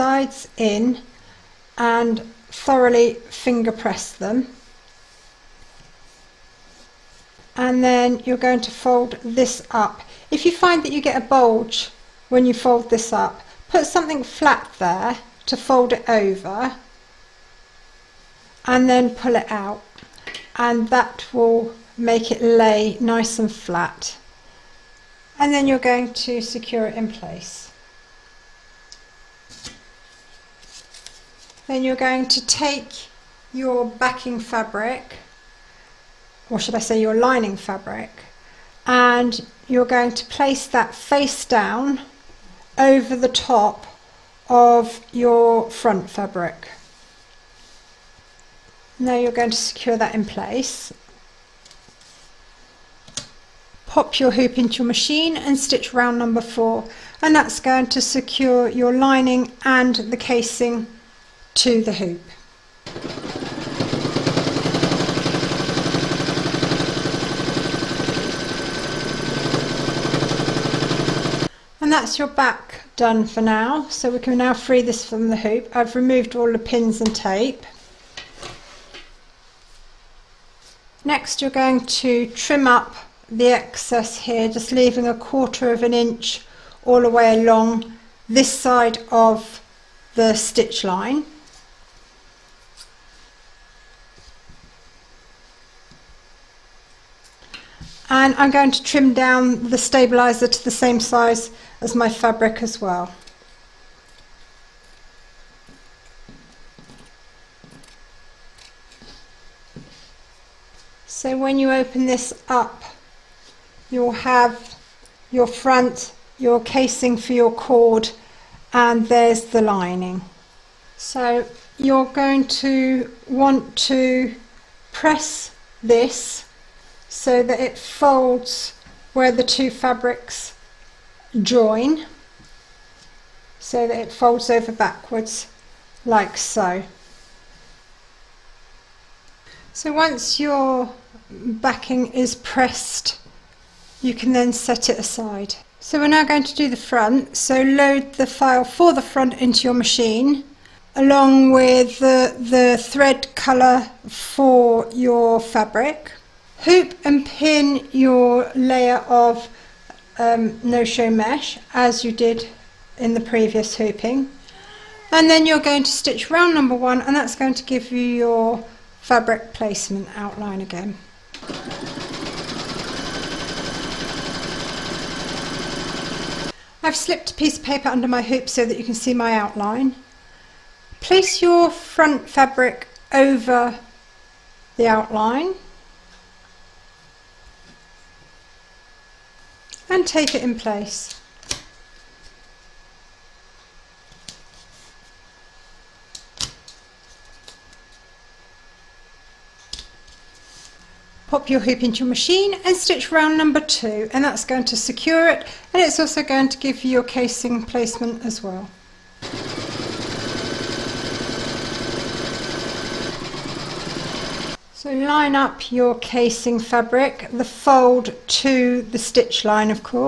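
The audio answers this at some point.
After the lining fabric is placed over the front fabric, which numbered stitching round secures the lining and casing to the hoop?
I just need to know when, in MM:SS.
00:56.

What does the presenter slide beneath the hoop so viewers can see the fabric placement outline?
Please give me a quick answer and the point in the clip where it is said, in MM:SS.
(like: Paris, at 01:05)
a piece of paper, at 02:57.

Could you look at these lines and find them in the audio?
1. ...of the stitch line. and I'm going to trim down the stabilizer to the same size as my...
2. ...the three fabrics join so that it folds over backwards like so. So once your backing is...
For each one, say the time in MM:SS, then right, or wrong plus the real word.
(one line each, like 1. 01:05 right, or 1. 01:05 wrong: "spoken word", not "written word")
1. 01:29 right
2. 02:09 wrong: "two", not "three".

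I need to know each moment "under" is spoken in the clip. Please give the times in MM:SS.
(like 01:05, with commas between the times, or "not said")
02:57.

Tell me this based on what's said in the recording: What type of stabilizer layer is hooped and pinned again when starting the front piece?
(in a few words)
no-show mesh.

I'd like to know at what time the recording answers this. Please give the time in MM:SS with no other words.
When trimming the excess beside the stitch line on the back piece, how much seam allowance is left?
01:25.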